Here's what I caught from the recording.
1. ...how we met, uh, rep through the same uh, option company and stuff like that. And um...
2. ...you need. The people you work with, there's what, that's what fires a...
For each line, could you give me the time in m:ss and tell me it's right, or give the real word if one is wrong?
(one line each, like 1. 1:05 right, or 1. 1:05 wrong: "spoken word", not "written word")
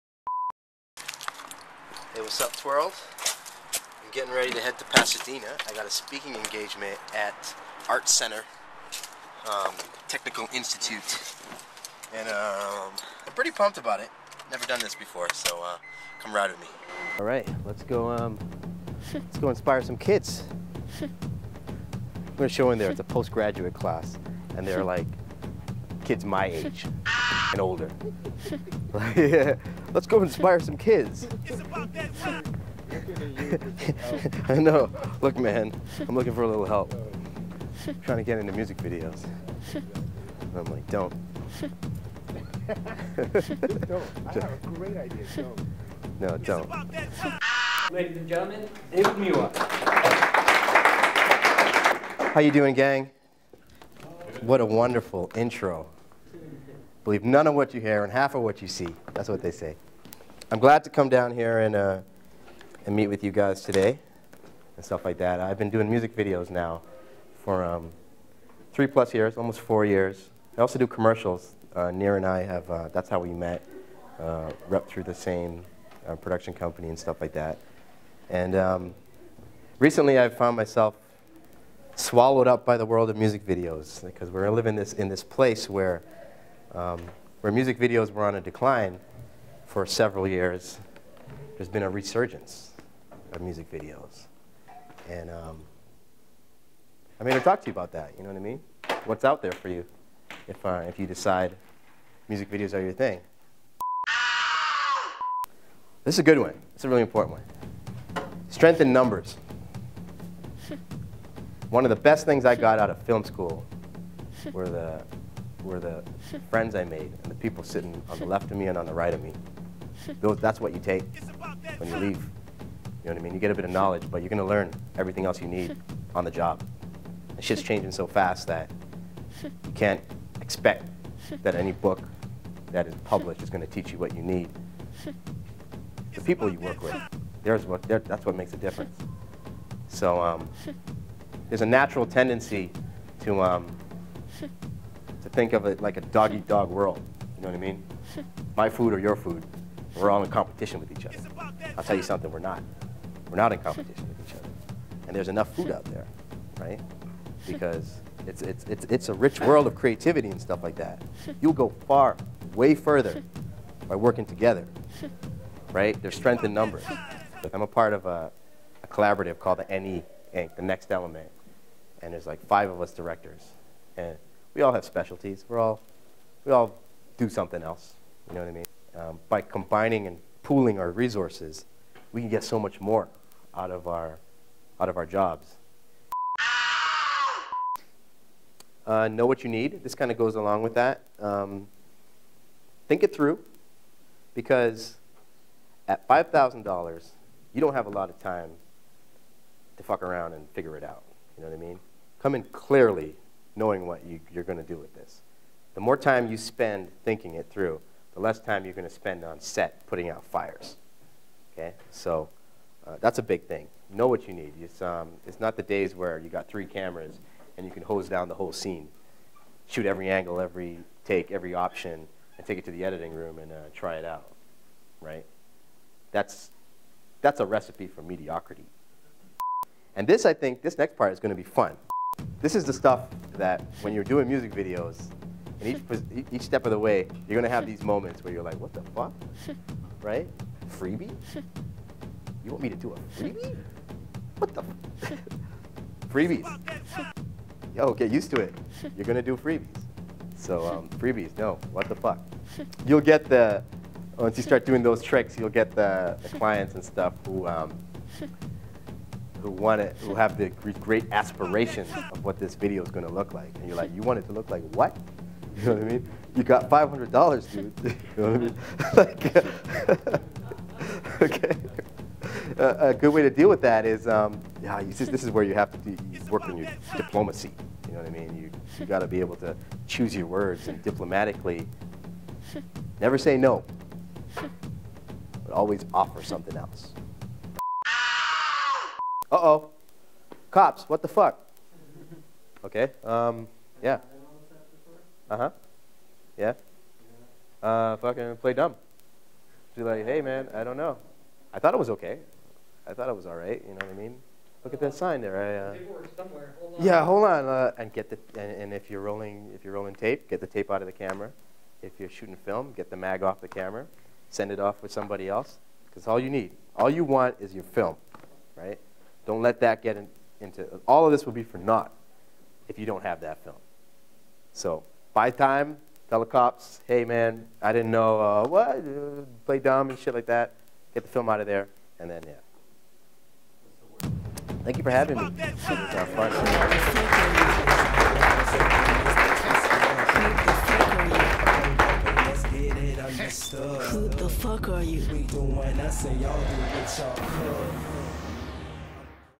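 1. 1:13 wrong: "production", not "option"
2. 2:14 wrong: "makes", not "fires".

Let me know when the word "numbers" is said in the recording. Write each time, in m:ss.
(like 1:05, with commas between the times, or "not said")
1:48, 2:46.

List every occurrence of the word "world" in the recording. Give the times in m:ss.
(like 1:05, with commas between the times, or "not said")
1:22, 2:26, 2:39.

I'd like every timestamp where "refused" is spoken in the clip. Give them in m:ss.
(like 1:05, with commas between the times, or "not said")
not said.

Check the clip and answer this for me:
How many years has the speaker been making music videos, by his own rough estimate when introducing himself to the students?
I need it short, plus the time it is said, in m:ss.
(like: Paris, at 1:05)
almost 4 years, at 1:09.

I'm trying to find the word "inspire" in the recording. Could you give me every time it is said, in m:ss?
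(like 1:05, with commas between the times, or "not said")
0:19, 0:30.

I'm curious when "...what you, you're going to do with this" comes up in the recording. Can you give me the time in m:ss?
3:23.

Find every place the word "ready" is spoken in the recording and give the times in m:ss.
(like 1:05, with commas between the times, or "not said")
0:04.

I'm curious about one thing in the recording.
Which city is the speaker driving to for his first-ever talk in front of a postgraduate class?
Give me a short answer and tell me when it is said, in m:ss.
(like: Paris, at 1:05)
Pasadena, at 0:04.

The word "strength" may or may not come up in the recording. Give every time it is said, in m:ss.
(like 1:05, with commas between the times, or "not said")
1:48, 2:46.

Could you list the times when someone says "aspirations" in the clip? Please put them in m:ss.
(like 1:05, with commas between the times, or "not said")
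4:21.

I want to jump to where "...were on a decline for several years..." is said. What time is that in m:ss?
1:28.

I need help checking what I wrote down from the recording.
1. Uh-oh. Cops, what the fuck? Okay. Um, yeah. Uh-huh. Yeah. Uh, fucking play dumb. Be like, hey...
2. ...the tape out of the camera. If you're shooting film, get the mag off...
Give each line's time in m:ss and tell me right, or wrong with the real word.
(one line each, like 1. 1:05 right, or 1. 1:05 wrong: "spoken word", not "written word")
1. 4:49 right
2. 5:10 right.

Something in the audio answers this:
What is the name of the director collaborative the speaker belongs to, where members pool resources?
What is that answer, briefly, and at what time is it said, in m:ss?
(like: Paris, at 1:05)
The Next Element, at 2:50.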